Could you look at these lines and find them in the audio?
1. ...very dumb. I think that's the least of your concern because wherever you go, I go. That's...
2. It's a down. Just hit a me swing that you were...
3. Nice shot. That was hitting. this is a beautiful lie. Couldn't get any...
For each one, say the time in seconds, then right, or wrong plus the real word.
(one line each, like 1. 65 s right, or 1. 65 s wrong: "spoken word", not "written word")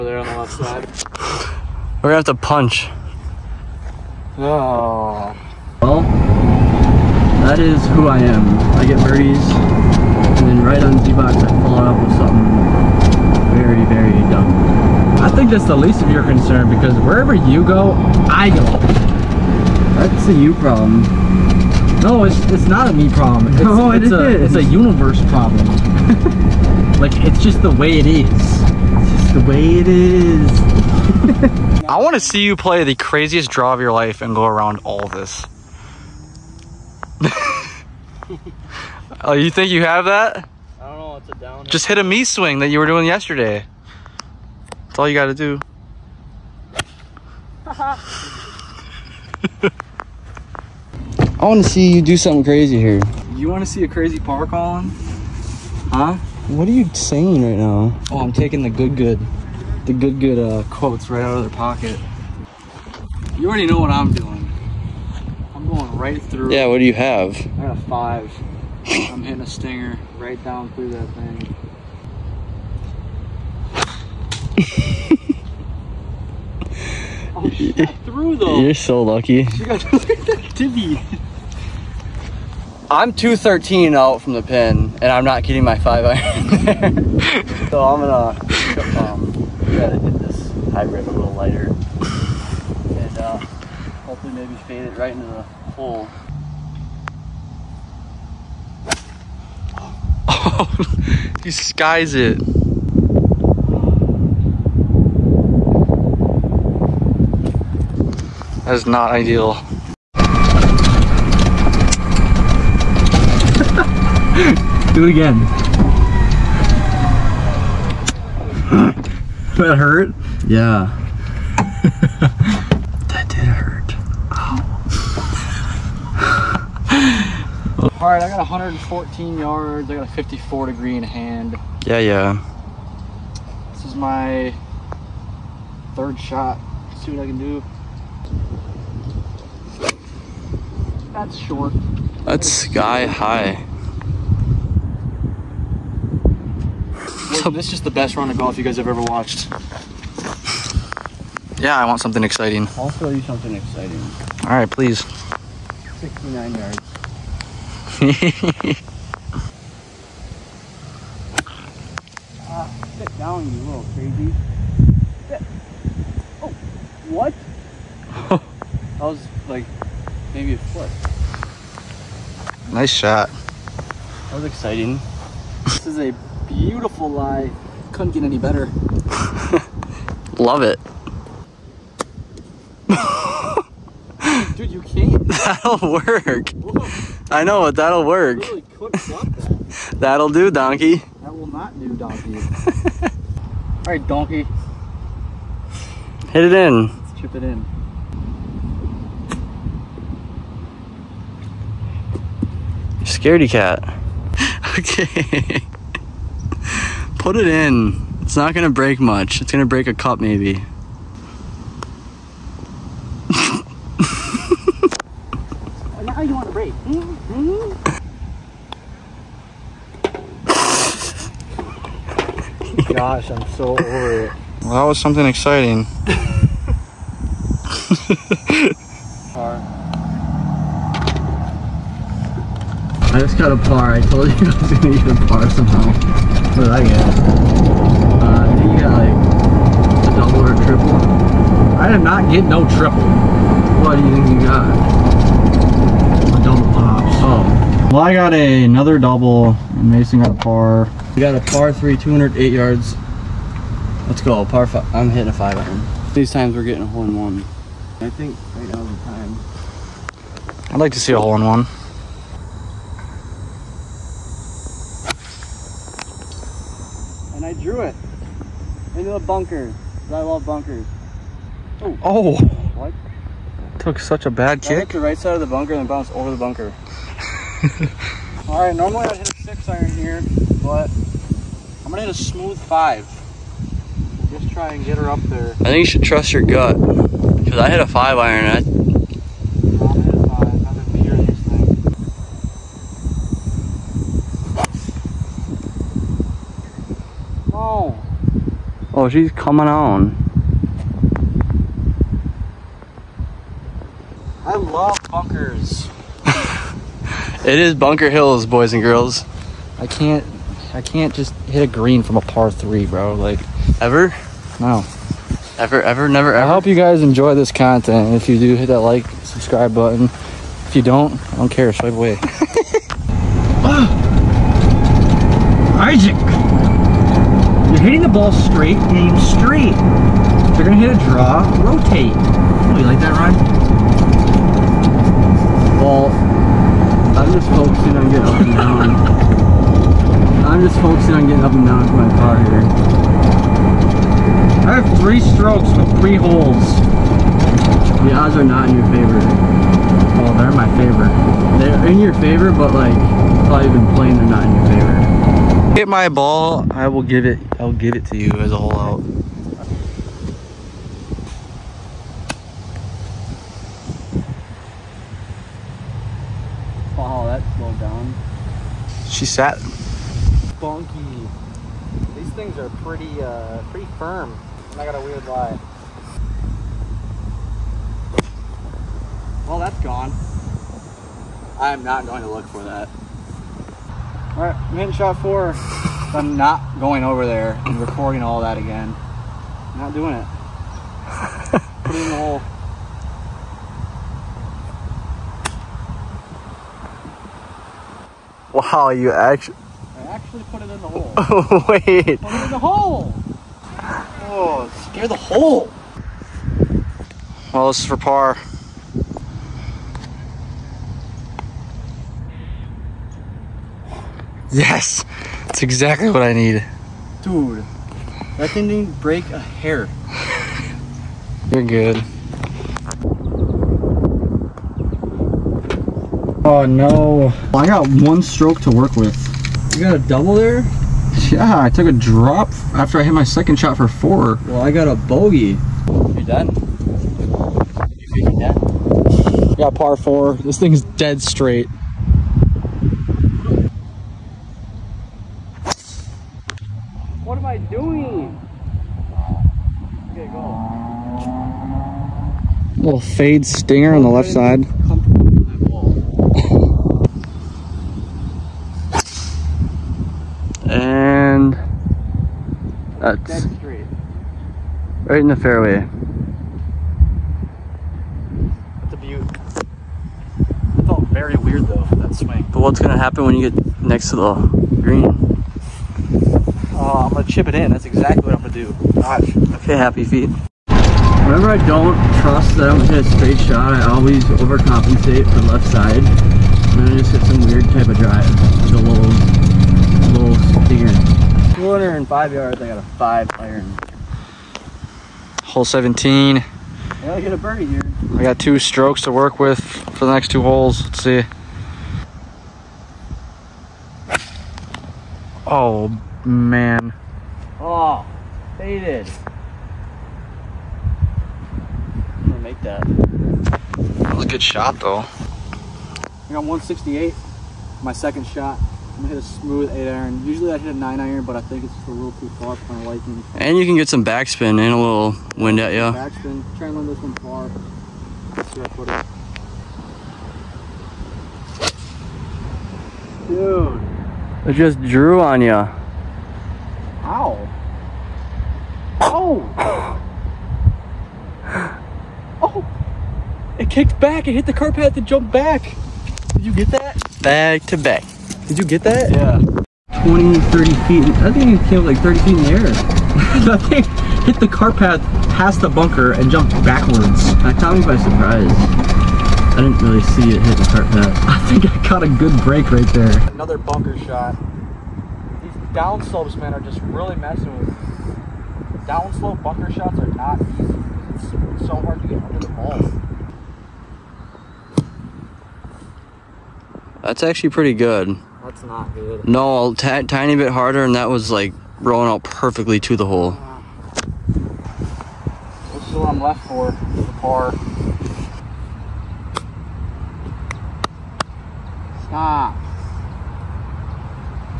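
1. 13 s right
2. 41 s right
3. 172 s wrong: "exciting", not "hitting".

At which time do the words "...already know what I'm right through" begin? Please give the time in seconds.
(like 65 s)
63 s.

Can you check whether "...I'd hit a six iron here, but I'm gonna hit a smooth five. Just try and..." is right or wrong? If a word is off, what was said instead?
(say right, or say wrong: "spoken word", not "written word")
right.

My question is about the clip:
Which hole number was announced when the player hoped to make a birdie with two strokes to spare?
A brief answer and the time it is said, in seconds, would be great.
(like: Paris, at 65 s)
17, at 495 s.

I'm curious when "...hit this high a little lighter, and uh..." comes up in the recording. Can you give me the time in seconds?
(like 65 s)
89 s.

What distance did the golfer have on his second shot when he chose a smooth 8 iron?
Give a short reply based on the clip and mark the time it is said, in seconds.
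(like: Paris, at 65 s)
168, at 516 s.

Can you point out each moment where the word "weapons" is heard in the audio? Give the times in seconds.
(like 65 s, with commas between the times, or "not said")
not said.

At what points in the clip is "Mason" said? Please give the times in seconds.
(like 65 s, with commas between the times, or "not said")
249 s.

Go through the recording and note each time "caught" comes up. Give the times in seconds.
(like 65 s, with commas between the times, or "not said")
557 s, 561 s.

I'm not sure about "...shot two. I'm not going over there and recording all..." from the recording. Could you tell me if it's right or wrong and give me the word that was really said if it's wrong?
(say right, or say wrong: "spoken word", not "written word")
wrong: "four", not "two".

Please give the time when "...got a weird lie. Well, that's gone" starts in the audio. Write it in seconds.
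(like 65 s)
374 s.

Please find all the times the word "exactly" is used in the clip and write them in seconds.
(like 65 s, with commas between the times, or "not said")
415 s, 477 s.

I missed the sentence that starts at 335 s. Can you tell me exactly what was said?
Well, I'm just focusing on getting up and down.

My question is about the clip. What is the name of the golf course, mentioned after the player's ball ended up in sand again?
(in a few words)
Bunker Hills.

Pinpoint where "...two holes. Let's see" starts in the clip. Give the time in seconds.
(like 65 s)
500 s.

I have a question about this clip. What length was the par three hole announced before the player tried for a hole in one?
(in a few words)
208 yards.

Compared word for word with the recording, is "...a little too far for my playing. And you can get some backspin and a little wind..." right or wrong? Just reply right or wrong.
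wrong.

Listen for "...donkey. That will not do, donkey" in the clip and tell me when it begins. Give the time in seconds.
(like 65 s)
190 s.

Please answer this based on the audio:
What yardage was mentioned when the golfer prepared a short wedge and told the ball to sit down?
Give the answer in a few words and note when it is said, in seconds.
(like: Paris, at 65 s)
69 yards, at 155 s.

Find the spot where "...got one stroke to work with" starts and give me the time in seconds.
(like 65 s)
427 s.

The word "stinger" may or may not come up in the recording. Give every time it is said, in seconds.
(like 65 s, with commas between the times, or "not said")
69 s, 453 s, 490 s.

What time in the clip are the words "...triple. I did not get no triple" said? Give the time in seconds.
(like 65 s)
240 s.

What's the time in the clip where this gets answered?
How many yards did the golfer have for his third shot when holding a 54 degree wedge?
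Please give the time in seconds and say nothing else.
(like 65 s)
128 s.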